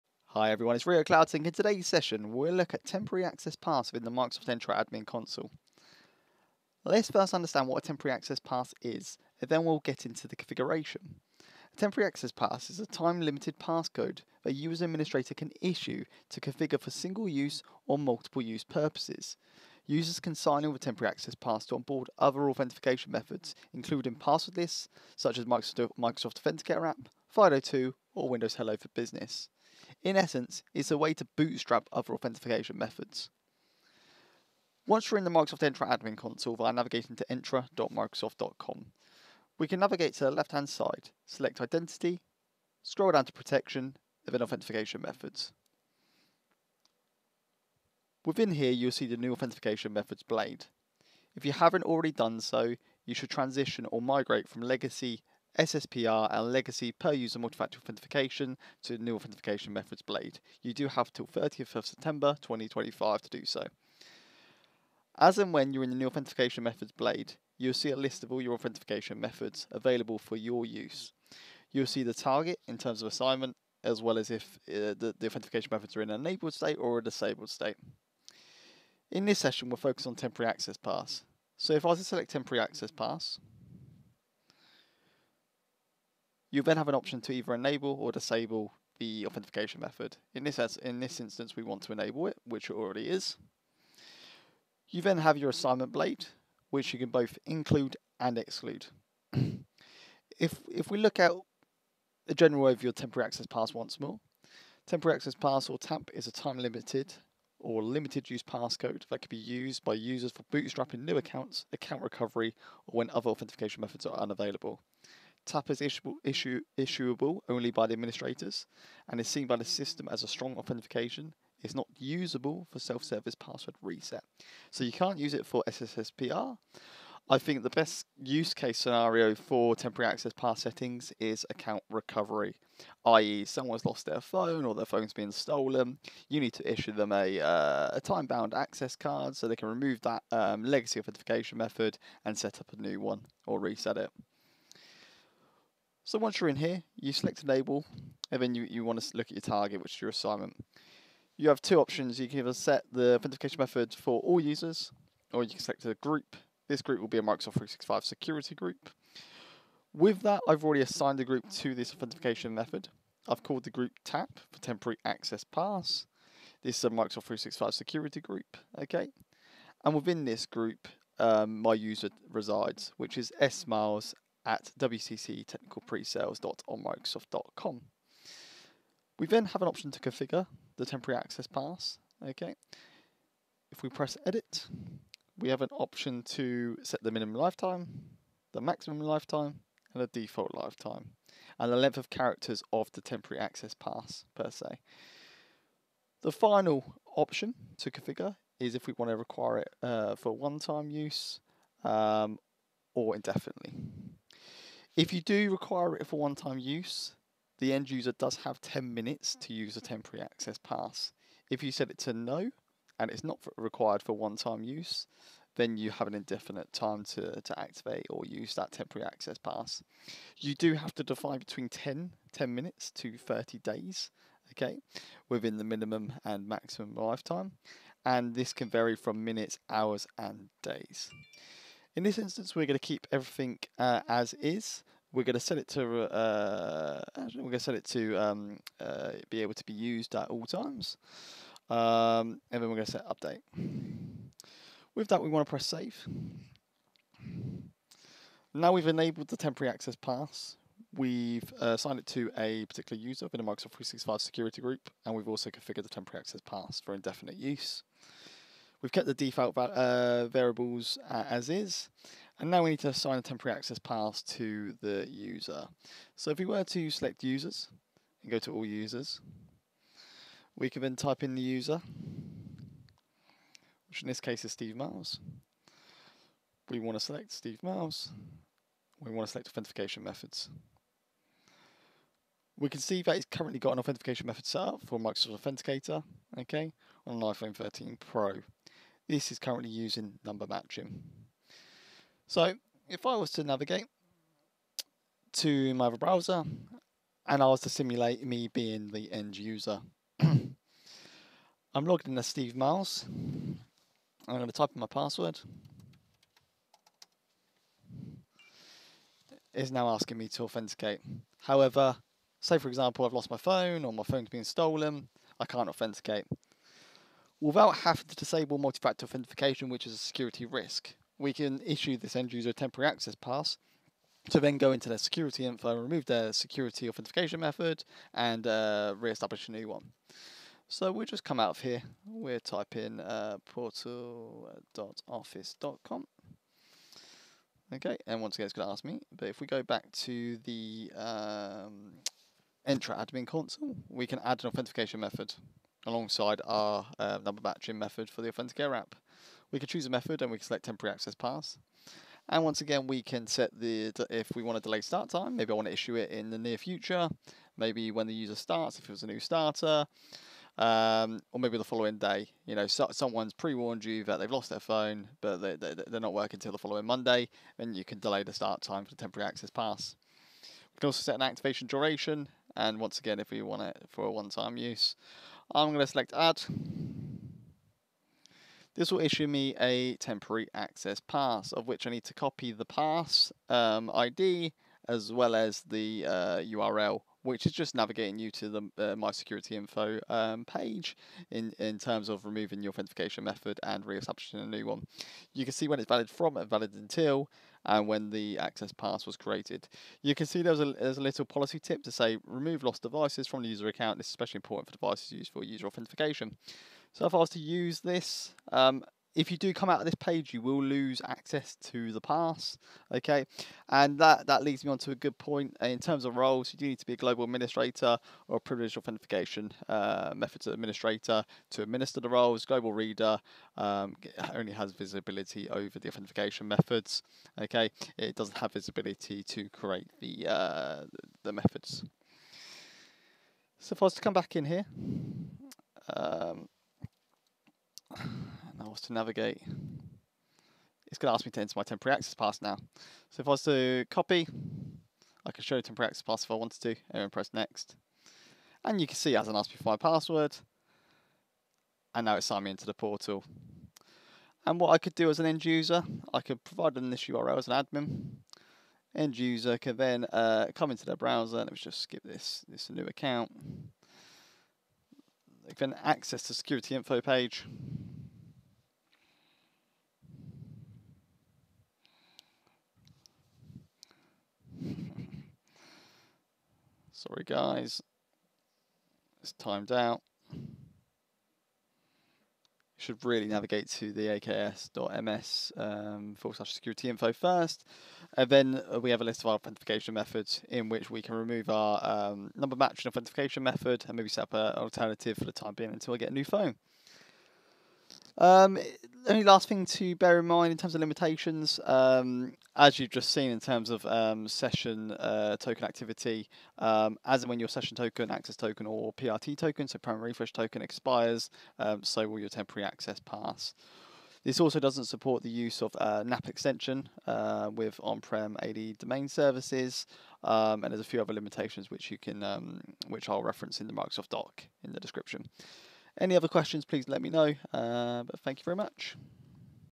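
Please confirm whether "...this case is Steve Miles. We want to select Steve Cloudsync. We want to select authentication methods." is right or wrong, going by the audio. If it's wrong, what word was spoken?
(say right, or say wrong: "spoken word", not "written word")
wrong: "Miles", not "Cloudsync".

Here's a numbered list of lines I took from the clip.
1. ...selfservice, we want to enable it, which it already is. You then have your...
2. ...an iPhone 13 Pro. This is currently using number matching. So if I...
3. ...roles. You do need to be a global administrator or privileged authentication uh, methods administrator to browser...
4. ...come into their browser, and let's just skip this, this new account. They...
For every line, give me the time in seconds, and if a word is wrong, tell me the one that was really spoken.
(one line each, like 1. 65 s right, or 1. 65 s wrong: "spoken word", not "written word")
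1. 91 s wrong: "instance", not "selfservice"
2. 287 s right
3. 416 s wrong: "administer", not "browser"
4. 460 s right.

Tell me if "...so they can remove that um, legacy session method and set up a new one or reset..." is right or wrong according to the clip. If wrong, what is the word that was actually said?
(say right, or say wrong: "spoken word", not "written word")
wrong: "authentication", not "session".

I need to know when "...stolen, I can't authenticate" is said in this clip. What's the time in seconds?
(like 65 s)
314 s.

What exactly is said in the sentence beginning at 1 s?
In today's session, we'll look at temporary access paths within the Microsoft Entra Admin Console.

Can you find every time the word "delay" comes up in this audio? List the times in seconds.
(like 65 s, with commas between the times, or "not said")
354 s, 367 s.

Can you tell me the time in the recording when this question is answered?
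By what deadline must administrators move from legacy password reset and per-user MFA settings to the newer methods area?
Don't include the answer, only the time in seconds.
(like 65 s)
61 s.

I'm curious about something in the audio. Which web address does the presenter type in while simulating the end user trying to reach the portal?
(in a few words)
portal.office.com.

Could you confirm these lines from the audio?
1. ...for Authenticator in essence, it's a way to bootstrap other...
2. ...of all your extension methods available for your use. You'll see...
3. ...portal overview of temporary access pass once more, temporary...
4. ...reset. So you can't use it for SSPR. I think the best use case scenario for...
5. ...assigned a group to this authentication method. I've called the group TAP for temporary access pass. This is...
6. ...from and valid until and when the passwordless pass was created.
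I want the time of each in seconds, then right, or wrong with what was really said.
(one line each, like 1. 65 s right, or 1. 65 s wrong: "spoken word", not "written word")
1. 28 s wrong: "Business", not "Authenticator"
2. 68 s wrong: "authentication", not "extension"
3. 102 s wrong: "general", not "portal"
4. 123 s right
5. 160 s right
6. 396 s wrong: "access", not "passwordless".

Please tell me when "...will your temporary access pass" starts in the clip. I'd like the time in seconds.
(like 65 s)
512 s.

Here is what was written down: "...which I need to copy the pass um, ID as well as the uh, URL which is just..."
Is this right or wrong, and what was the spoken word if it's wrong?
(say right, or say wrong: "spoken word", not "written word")
right.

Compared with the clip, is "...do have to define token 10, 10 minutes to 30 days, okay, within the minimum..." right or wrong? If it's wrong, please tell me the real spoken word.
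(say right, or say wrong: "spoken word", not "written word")
wrong: "between", not "token".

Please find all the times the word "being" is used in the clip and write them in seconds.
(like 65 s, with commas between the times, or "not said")
298 s, 495 s.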